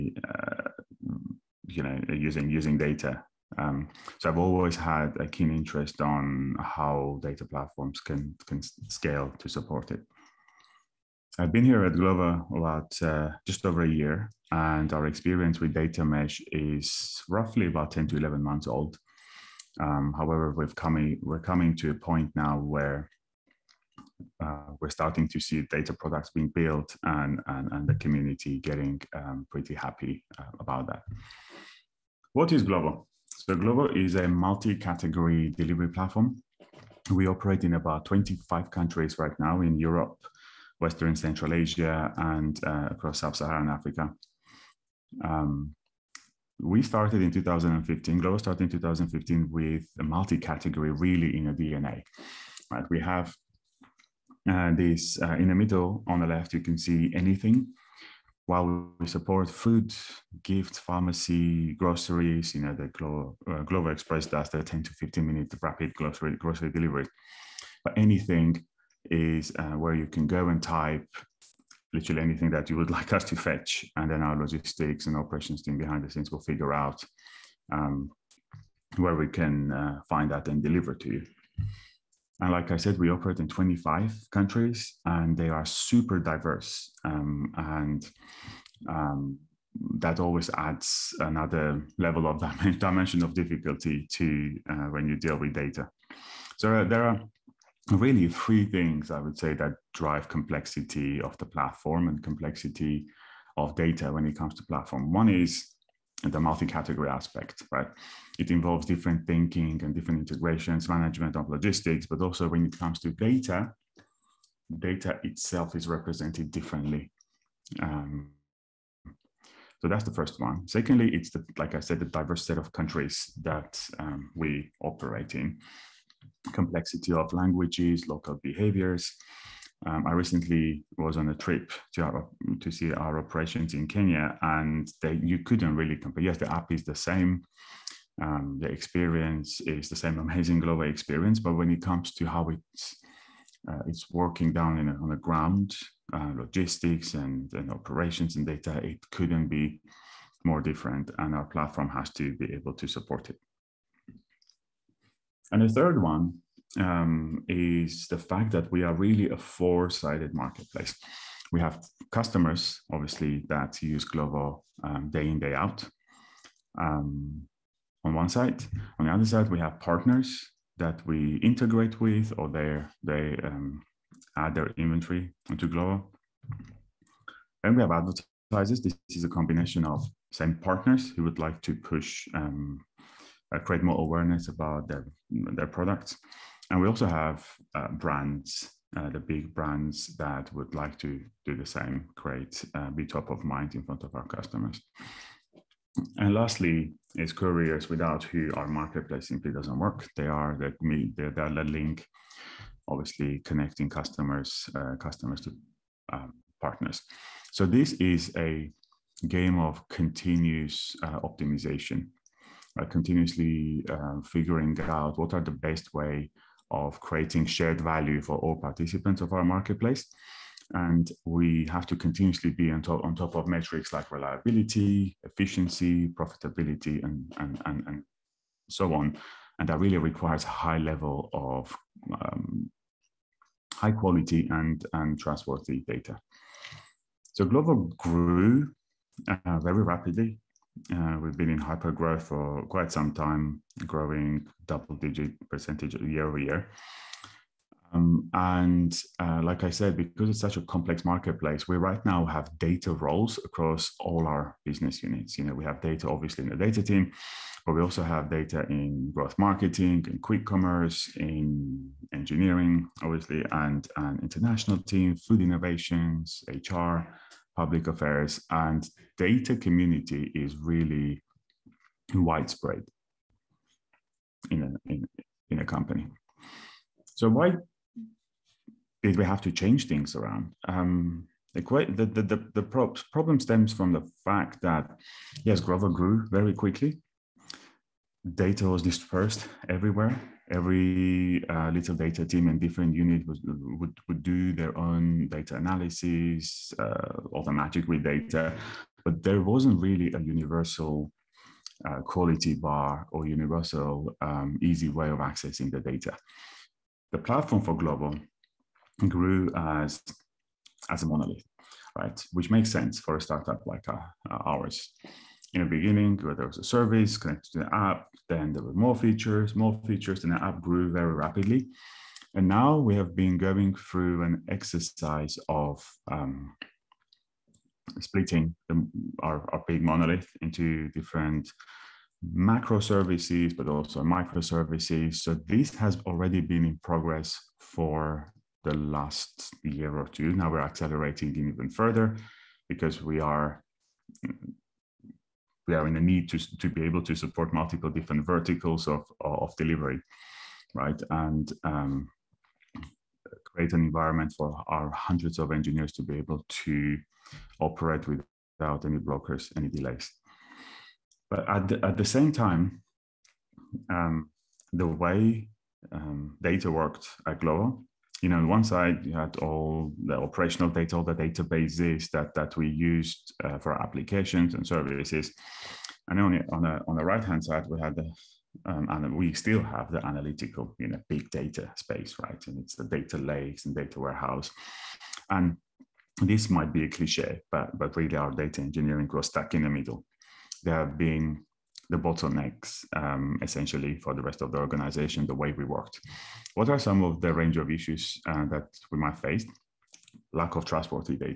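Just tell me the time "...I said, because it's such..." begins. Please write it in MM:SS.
04:09.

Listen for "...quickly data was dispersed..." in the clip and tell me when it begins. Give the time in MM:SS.
04:46.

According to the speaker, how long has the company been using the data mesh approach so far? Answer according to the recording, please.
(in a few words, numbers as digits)
10 to 11 months.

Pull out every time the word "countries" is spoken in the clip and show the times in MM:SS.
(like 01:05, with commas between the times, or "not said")
00:38, 01:24, 02:02.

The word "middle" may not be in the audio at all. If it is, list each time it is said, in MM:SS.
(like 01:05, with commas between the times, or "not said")
00:55, 06:29.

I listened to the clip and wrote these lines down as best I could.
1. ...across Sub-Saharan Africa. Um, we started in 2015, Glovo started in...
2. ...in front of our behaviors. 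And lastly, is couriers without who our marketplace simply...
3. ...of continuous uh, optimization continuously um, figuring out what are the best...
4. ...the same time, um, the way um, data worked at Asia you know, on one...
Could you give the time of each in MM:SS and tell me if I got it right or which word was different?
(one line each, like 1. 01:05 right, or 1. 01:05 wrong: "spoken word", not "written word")
1. 00:42 right
2. 03:13 wrong: "customers", not "behaviors"
3. 03:29 right
4. 06:01 wrong: "Glovo", not "Asia".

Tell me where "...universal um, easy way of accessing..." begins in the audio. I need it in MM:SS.
05:03.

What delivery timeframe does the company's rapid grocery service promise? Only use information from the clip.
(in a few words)
10 to 15 minutes.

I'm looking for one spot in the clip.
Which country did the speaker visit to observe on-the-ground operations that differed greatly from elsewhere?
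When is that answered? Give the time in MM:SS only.
02:13.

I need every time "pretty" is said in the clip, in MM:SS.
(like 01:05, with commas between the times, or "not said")
00:29.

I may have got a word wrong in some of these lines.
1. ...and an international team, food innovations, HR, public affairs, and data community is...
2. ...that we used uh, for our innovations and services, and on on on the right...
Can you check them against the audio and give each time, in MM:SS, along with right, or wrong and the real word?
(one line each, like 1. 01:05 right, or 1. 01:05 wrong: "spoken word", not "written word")
1. 04:23 right
2. 06:12 wrong: "applications", not "innovations".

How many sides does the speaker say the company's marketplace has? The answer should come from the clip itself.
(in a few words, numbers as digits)
four.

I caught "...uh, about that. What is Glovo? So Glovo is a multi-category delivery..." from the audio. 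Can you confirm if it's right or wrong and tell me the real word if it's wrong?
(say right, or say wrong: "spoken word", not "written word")
right.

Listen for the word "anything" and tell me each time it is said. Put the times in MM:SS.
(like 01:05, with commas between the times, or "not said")
00:57, 01:07, 01:12.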